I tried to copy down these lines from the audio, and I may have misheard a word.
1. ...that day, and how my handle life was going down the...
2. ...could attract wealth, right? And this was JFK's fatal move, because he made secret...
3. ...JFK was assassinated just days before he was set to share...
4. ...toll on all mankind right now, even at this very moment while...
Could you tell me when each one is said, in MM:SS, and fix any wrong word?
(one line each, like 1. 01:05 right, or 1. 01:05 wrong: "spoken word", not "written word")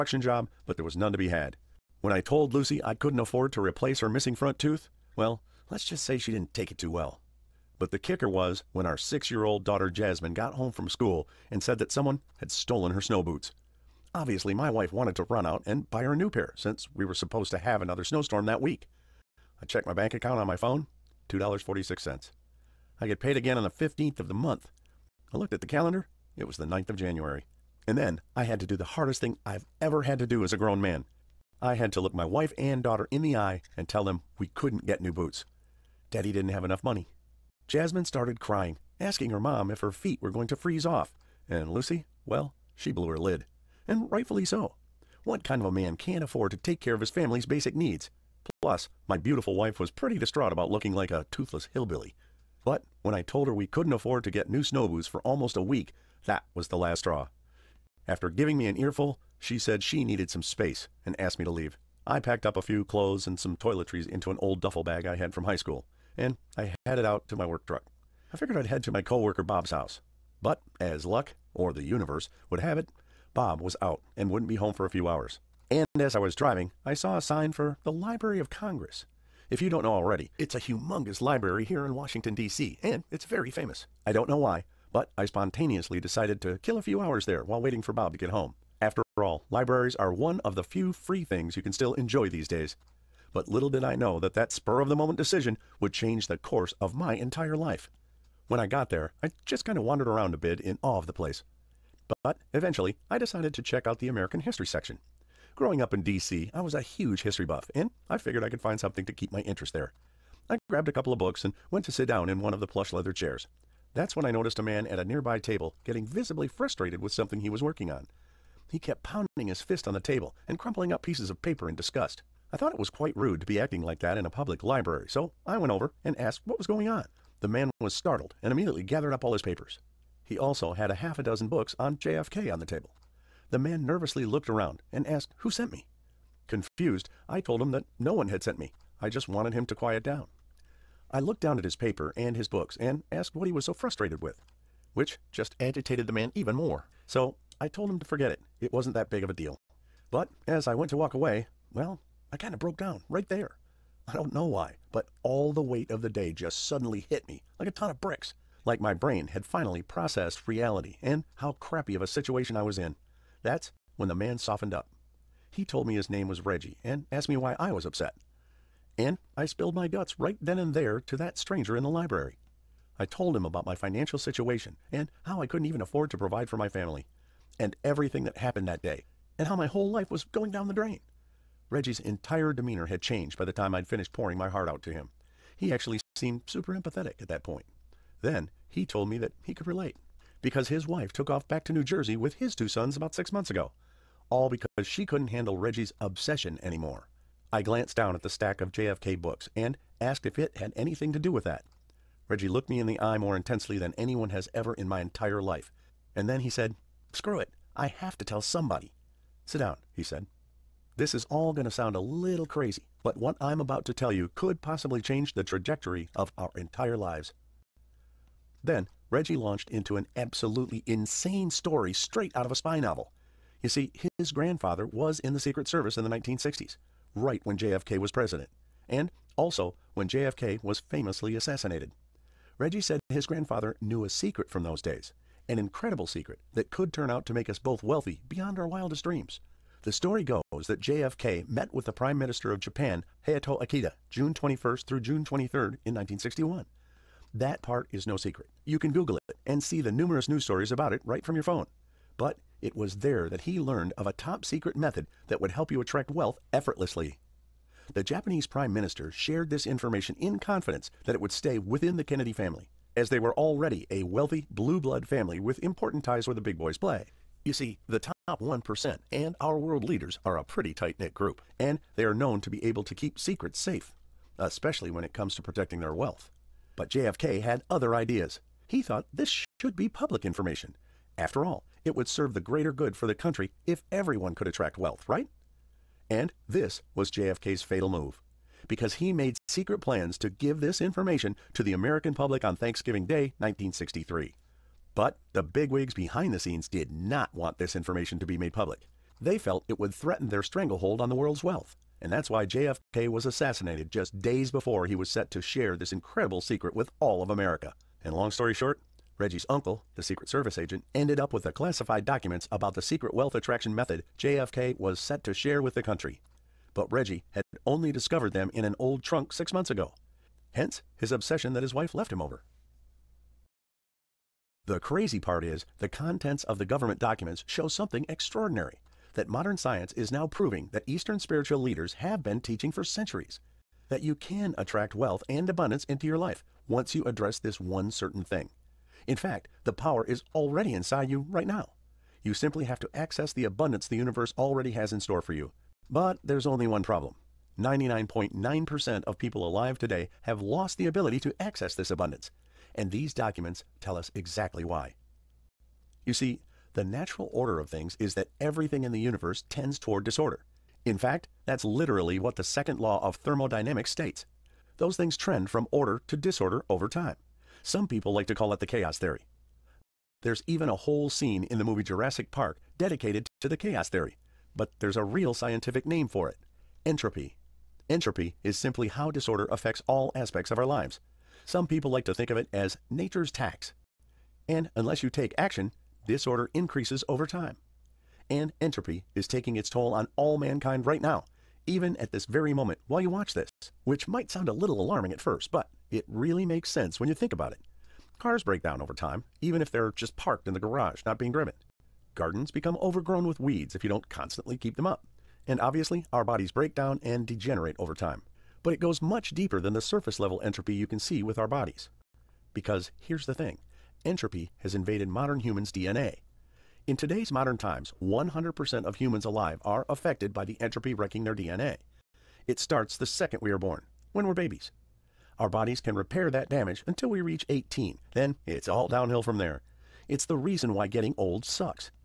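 1. 02:58 wrong: "whole", not "handle"
2. 04:44 right
3. 05:02 right
4. 06:29 right.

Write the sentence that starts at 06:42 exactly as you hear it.
Gardens become overgrown with weeds if you don't constantly keep them up.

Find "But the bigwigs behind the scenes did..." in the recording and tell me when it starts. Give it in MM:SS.
04:54.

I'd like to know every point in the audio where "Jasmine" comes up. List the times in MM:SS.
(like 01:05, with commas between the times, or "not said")
00:09, 00:37.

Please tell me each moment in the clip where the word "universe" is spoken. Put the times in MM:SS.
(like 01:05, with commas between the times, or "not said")
01:11, 05:43, 05:58.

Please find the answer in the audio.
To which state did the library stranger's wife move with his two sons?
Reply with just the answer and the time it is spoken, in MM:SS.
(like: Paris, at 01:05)
New Jersey, at 03:11.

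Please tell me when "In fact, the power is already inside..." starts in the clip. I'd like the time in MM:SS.
05:39.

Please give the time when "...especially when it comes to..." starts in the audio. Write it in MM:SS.
04:34.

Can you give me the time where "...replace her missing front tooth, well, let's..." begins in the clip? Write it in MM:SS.
00:03.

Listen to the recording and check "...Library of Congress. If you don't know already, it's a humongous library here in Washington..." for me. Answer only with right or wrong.
right.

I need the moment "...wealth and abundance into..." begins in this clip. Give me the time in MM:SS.
05:34.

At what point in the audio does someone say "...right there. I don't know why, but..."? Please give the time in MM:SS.
02:33.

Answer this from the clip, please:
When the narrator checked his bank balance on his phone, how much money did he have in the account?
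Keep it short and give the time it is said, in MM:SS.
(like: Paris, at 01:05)
$2.46, at 00:21.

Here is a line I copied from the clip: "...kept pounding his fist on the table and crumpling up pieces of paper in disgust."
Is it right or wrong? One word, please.
right.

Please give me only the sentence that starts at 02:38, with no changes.
Like my brain had finally processed reality and how crappy of a situation I was in.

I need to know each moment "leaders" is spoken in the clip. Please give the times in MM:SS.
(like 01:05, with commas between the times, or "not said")
04:29, 05:31.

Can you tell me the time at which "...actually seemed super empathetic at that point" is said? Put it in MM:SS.
03:05.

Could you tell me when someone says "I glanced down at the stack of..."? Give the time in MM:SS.
03:17.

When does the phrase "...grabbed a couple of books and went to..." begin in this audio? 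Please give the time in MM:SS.
01:50.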